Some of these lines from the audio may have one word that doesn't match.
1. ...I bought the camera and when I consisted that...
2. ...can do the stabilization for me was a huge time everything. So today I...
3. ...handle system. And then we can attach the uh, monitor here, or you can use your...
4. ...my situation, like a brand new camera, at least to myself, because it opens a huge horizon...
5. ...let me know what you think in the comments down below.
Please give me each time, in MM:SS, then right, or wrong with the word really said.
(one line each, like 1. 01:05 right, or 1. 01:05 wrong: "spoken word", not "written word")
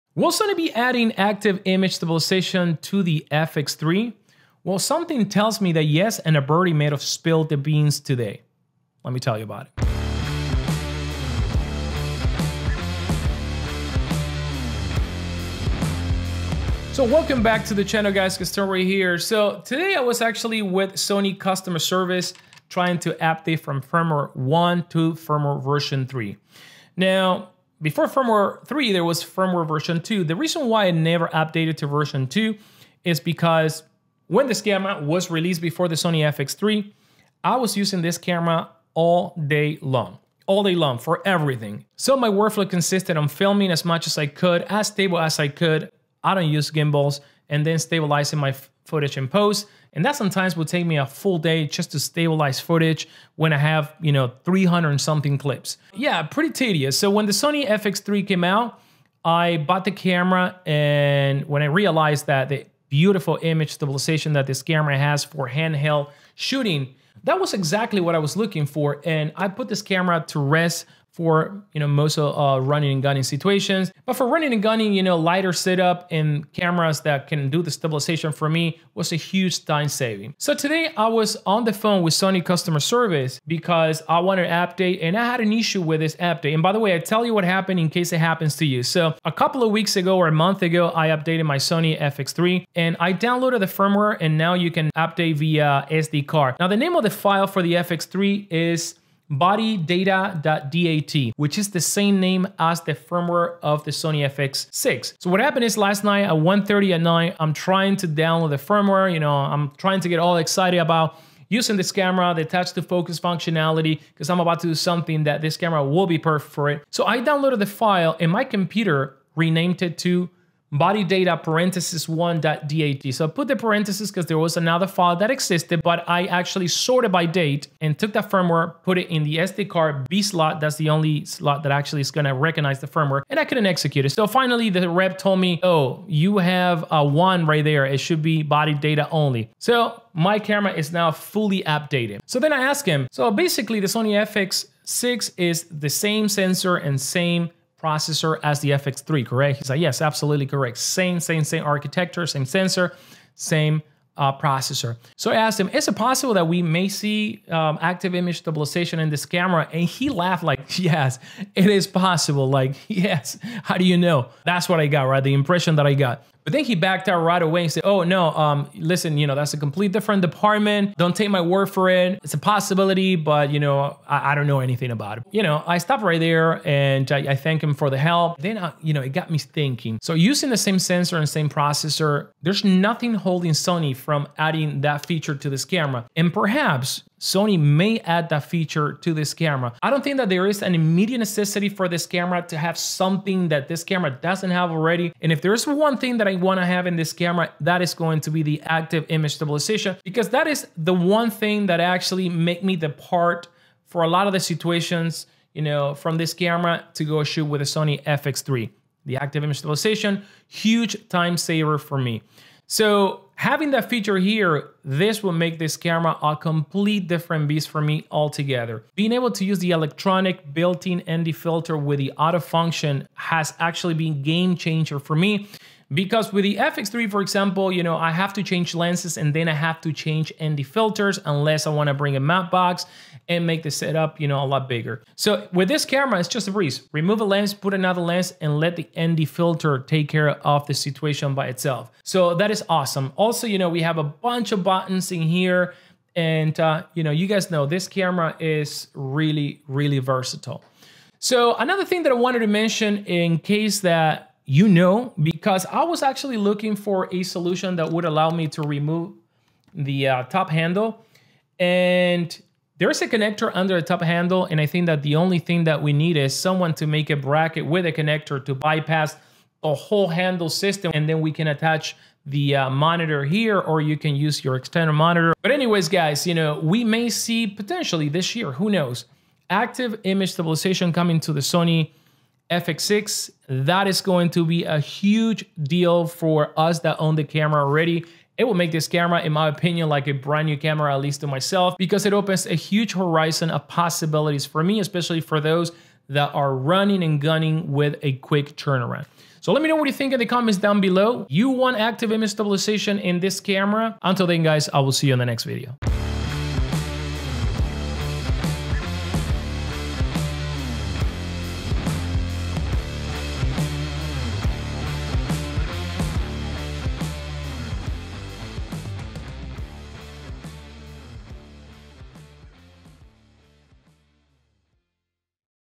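1. 00:59 wrong: "realized", not "consisted"
2. 01:17 wrong: "saving", not "everything"
3. 04:30 right
4. 04:49 wrong: "opinion", not "situation"
5. 04:59 right.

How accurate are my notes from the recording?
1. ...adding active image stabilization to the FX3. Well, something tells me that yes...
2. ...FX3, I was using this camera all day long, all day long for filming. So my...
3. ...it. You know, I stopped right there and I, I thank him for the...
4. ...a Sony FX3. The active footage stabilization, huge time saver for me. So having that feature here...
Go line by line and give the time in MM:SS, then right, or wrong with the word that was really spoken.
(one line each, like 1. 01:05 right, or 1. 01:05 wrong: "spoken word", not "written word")
1. 00:00 right
2. 00:36 wrong: "everything", not "filming"
3. 02:55 right
4. 03:27 wrong: "image", not "footage".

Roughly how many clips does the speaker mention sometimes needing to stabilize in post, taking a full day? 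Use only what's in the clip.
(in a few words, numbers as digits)
300 something.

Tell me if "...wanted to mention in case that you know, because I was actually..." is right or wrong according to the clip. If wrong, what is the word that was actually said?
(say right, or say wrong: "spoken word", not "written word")
right.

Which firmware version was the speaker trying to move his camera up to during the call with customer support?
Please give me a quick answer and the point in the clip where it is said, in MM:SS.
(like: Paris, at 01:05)
3, at 00:25.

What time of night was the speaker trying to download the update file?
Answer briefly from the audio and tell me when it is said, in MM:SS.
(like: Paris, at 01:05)
1:30, at 01:46.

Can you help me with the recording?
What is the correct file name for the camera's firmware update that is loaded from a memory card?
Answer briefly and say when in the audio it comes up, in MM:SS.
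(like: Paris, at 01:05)
bodydata.dat, at 01:39.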